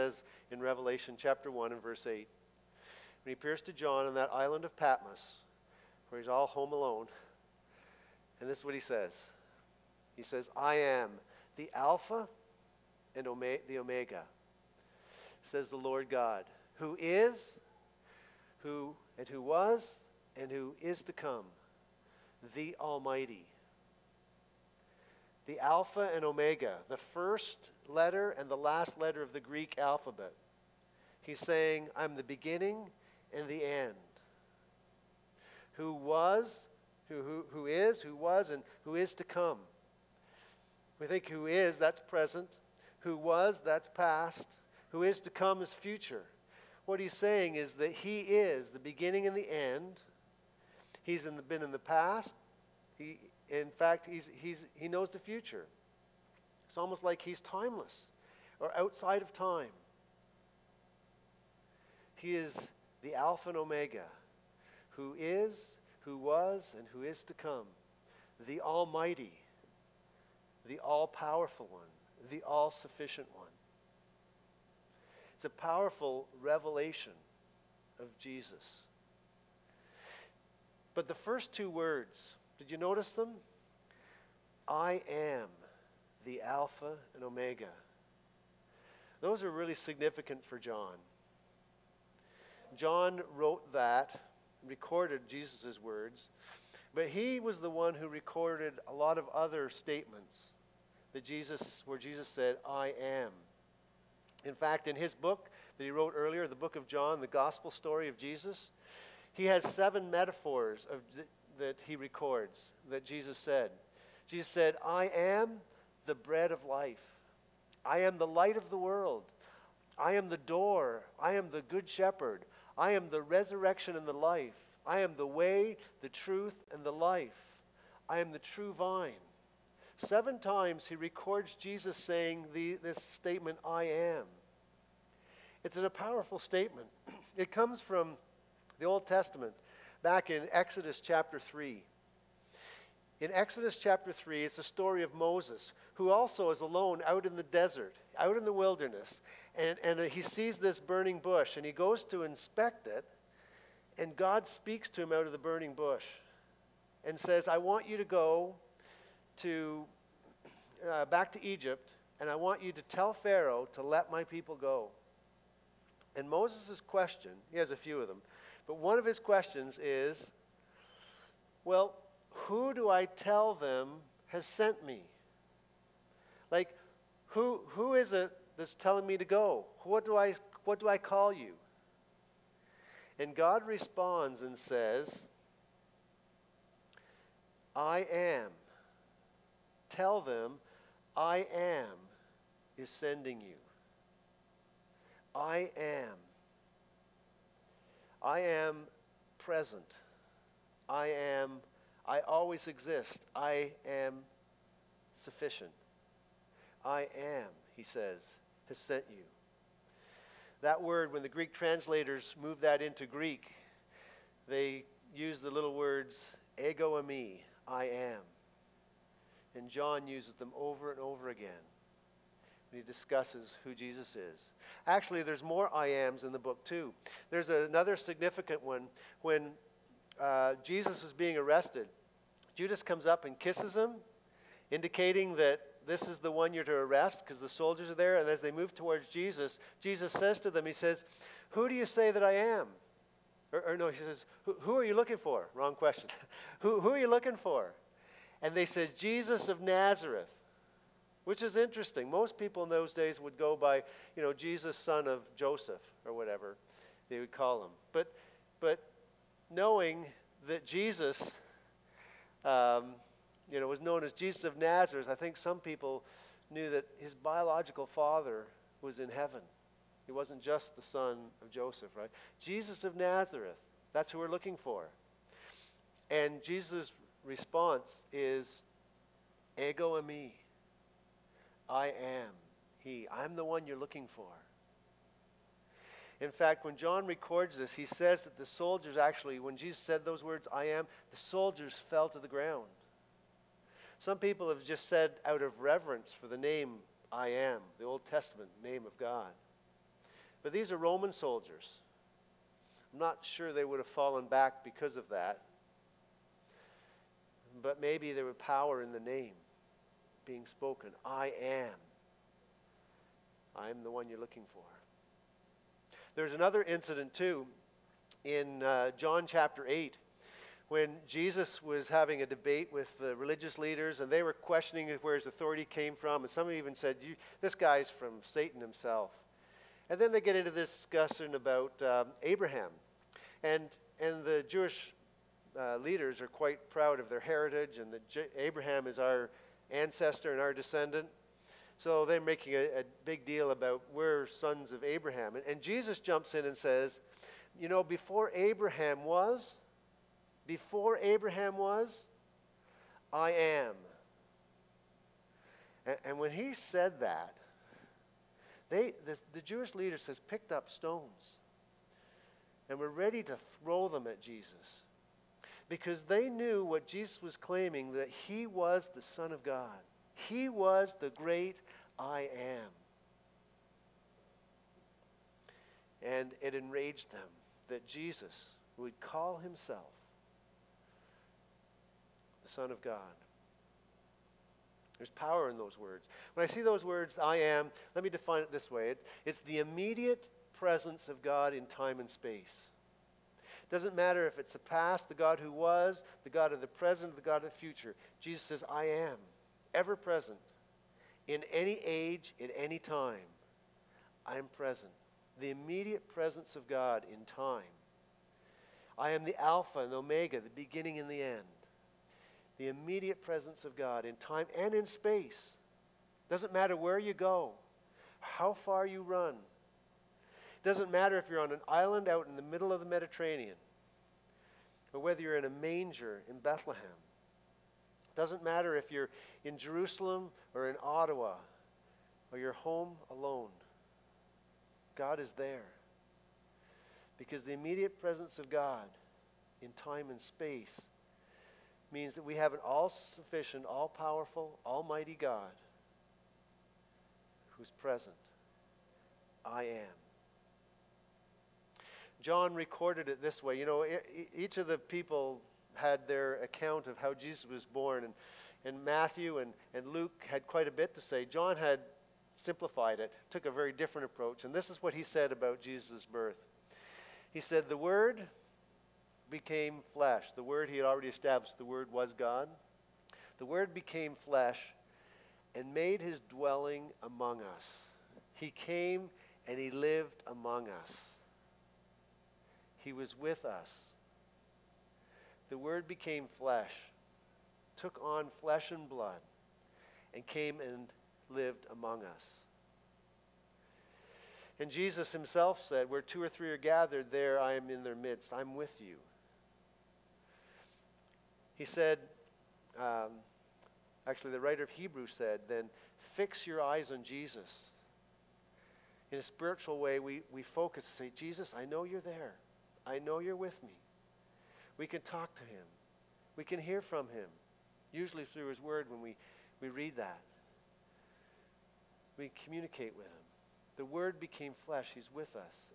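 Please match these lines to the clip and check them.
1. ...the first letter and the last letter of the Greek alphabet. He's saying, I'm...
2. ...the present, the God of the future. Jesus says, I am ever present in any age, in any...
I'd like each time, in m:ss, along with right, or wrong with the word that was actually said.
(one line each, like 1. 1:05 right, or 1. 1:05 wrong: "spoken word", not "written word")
1. 0:26 right
2. 6:36 right.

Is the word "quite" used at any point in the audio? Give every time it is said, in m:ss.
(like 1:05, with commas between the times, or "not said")
5:36, 7:40.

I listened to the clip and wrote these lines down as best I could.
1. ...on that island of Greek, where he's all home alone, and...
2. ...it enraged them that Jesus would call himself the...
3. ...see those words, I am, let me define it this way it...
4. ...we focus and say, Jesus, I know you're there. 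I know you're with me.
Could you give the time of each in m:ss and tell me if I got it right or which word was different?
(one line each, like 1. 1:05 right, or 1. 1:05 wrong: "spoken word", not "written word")
1. 0:04 wrong: "Patmos", not "Greek"
2. 6:16 right
3. 6:26 right
4. 8:30 right.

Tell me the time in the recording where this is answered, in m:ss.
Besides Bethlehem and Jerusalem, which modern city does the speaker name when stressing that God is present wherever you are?
7:10.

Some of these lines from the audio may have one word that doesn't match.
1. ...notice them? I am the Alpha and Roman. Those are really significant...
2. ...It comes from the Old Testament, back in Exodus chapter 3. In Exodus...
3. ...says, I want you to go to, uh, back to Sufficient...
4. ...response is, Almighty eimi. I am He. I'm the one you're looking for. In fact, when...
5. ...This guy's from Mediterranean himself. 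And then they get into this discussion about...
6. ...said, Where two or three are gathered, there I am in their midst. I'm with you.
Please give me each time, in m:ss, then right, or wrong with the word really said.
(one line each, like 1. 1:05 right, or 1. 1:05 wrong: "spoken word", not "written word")
1. 1:22 wrong: "Omega", not "Roman"
2. 2:17 right
3. 2:37 wrong: "Egypt", not "Sufficient"
4. 4:37 wrong: "Ego", not "Almighty"
5. 5:27 wrong: "Satan", not "Mediterranean"
6. 8:15 right.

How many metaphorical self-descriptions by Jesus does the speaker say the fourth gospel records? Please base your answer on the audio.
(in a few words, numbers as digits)
7.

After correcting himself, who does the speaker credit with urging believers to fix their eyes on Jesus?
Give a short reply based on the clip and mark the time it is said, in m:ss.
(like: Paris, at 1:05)
writer of Hebrews, at 8:24.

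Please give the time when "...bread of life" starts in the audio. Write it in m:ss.
1:56.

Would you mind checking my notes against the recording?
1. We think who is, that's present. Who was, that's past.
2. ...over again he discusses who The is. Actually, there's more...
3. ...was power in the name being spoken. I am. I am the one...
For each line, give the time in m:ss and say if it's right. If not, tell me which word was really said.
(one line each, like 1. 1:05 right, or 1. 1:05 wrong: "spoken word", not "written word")
1. 0:40 right
2. 3:40 wrong: "Jesus", not "The"
3. 5:08 right.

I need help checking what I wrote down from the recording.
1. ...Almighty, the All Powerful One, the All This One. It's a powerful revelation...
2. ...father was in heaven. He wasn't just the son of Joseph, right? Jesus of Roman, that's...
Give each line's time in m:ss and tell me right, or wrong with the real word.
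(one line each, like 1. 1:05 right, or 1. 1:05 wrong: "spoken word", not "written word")
1. 1:08 wrong: "Sufficient", not "This"
2. 4:27 wrong: "Nazareth", not "Roman".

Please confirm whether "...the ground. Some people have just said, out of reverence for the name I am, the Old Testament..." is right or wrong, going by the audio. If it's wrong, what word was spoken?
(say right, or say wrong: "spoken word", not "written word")
right.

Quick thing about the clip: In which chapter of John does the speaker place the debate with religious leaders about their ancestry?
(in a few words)
John chapter 8.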